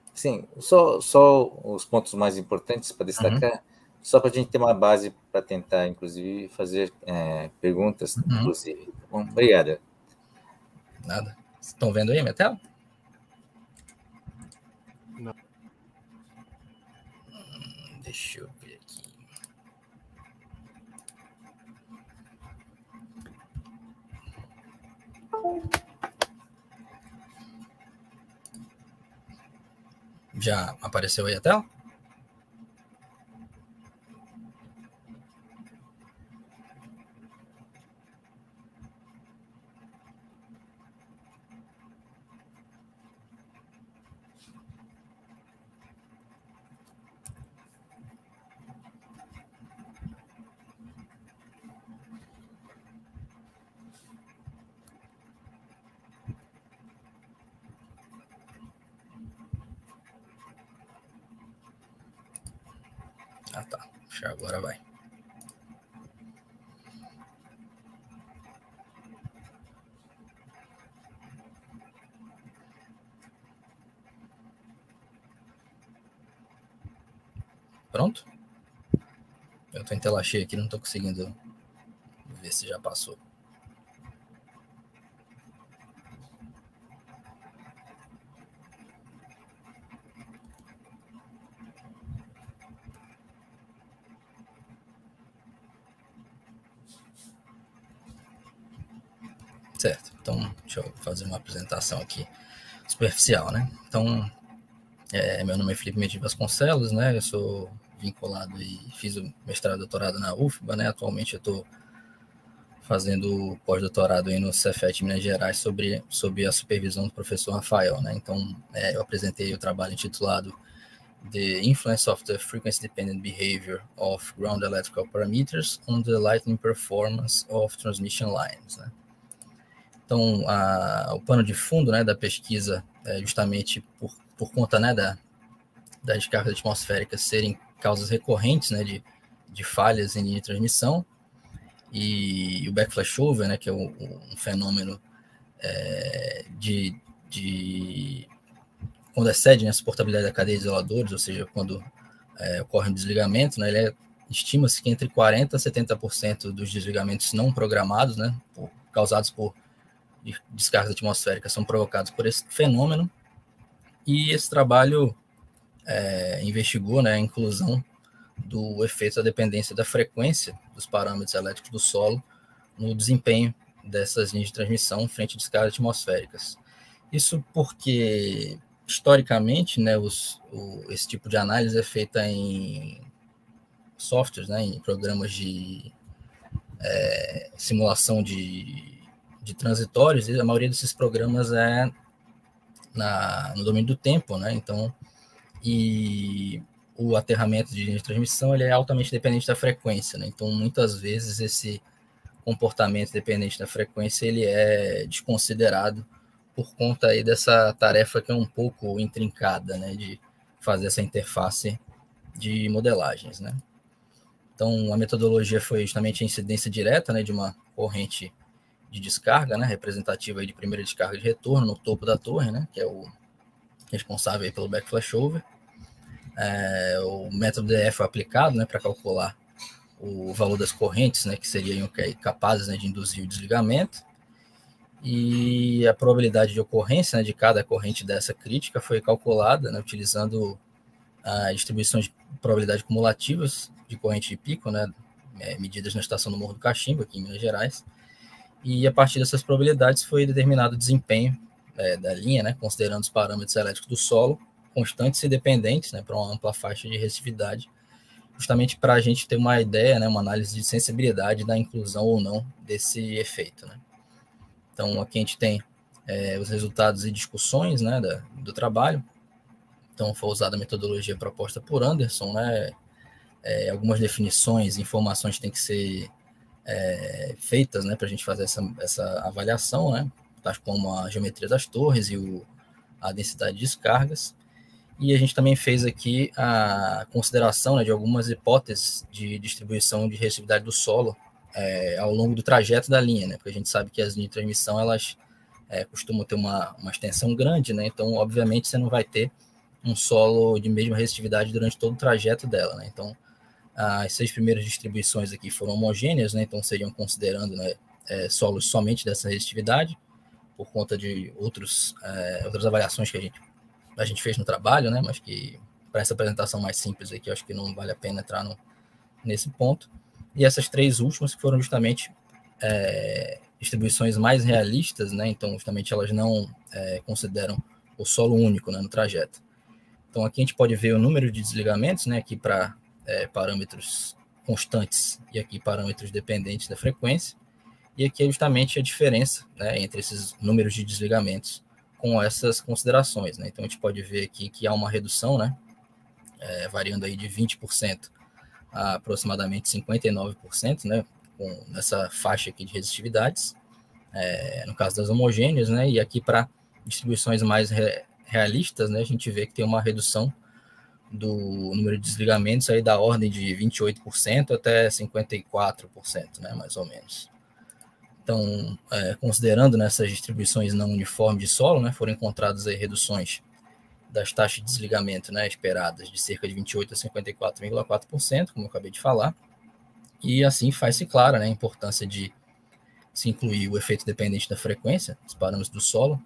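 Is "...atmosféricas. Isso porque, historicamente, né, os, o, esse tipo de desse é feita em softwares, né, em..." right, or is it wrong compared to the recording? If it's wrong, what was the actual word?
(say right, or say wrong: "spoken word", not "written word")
wrong: "análise", not "desse".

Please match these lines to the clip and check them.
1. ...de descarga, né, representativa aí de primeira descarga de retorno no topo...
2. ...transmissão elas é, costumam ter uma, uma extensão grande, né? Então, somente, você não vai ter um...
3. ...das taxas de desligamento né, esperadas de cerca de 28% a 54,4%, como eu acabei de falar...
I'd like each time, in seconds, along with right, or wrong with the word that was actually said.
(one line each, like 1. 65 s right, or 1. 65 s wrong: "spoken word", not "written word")
1. 218 s right
2. 294 s wrong: "obviamente", not "somente"
3. 374 s right.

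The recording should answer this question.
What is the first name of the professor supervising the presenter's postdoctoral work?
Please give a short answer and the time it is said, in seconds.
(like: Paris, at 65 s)
Rafael, at 117 s.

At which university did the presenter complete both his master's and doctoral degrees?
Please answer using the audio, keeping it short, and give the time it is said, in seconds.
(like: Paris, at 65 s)
UFBA, at 110 s.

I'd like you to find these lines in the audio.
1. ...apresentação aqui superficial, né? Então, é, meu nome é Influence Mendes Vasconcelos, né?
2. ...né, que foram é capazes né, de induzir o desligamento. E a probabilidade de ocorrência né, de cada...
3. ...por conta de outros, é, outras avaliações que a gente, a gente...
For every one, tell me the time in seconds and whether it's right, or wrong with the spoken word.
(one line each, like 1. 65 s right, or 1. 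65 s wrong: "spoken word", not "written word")
1. 101 s wrong: "Felipe", not "Influence"
2. 231 s wrong: "seriam", not "foram"
3. 310 s right.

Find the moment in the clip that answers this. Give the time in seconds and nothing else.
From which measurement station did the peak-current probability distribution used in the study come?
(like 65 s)
246 s.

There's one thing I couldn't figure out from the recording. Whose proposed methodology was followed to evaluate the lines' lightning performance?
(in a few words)
Anderson.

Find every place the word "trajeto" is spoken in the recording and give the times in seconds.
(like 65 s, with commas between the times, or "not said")
292 s, 301 s, 328 s.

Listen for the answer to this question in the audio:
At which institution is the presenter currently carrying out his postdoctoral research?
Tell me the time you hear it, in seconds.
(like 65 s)
114 s.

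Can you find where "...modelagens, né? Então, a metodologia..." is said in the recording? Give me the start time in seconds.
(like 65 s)
212 s.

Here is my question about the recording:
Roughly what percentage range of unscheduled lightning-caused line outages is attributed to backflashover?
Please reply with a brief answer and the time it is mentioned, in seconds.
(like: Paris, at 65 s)
40% to 70%, at 155 s.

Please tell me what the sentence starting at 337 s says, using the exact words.
E aqui é justamente a diferença né, entre esses números de desligamentos com essas considerações.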